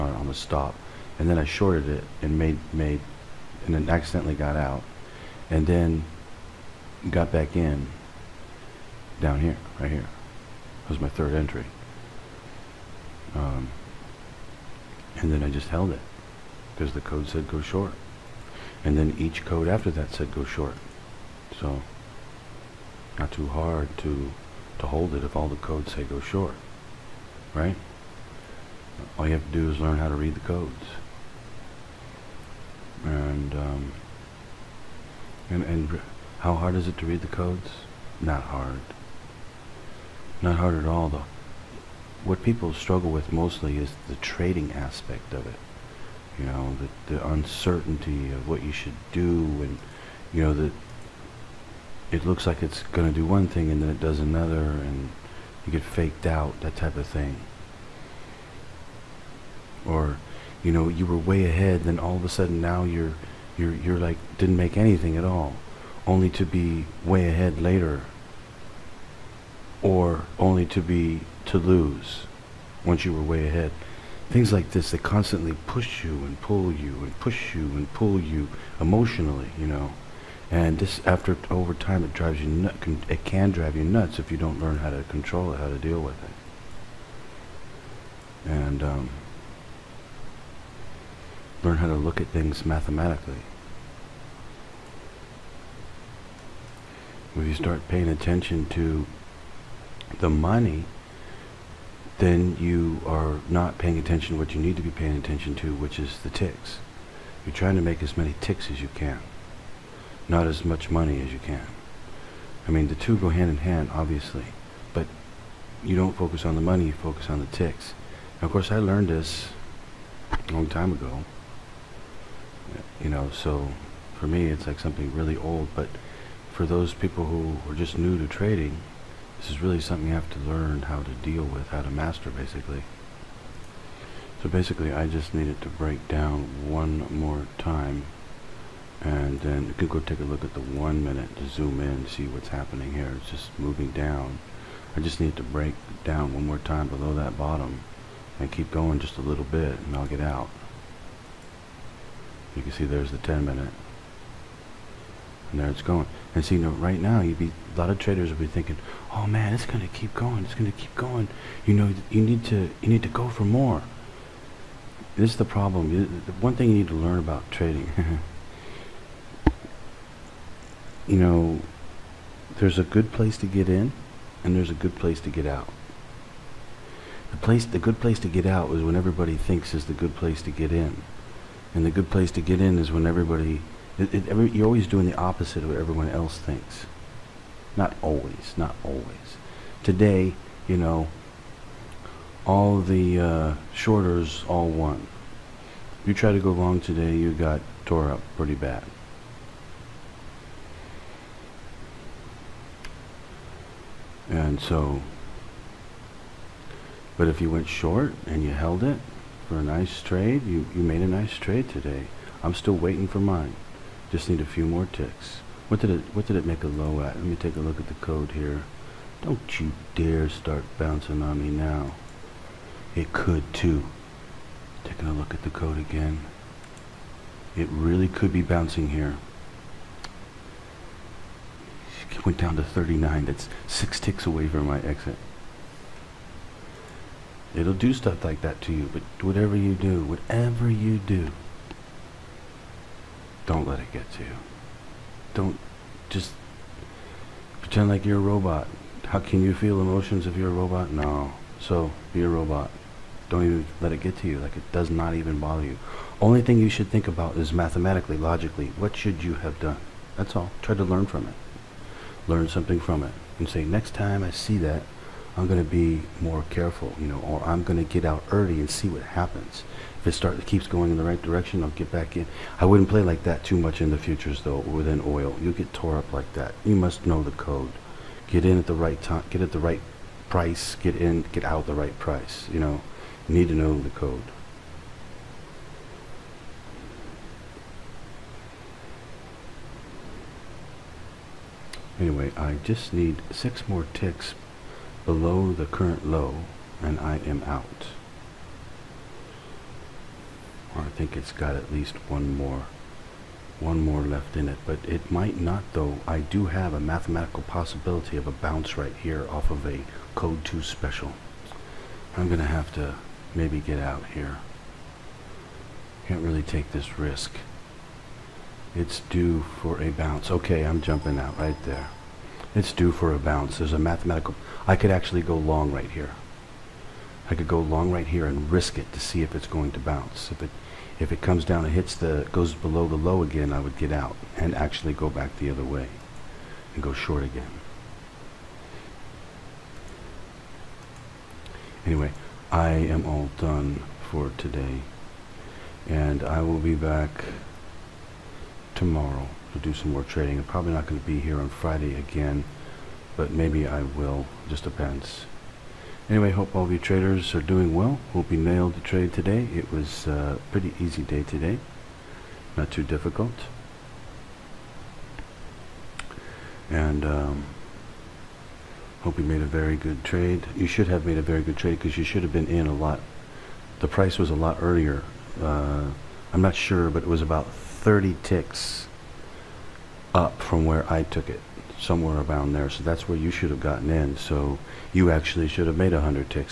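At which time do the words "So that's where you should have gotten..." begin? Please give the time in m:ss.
6:22.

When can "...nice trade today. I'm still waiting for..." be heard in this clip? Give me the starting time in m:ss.
3:31.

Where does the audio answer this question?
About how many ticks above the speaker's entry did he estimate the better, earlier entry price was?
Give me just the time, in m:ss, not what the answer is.
6:17.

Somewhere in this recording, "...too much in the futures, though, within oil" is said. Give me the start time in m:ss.
4:33.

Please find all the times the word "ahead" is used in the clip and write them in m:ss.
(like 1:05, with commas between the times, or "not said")
1:01, 1:07, 1:13.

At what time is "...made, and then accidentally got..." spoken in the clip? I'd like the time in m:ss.
0:02.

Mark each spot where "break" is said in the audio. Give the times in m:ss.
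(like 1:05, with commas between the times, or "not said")
2:15, 2:25.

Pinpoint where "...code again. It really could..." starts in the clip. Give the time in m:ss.
3:45.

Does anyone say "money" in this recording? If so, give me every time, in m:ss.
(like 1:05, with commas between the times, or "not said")
1:40, 1:50, 1:56.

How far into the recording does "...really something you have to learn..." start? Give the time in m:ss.
2:09.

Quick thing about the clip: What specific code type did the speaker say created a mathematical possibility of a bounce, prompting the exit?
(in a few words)
code 2 special.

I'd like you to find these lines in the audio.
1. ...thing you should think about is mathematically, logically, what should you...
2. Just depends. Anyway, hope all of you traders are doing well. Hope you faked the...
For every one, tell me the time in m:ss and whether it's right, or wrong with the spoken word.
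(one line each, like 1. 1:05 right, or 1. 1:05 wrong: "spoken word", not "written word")
1. 4:16 right
2. 5:54 wrong: "nailed", not "faked".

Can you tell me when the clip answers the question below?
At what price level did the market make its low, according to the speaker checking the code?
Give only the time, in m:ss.
3:52.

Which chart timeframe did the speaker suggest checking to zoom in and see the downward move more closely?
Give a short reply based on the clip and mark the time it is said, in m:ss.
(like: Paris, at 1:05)
one minute, at 2:20.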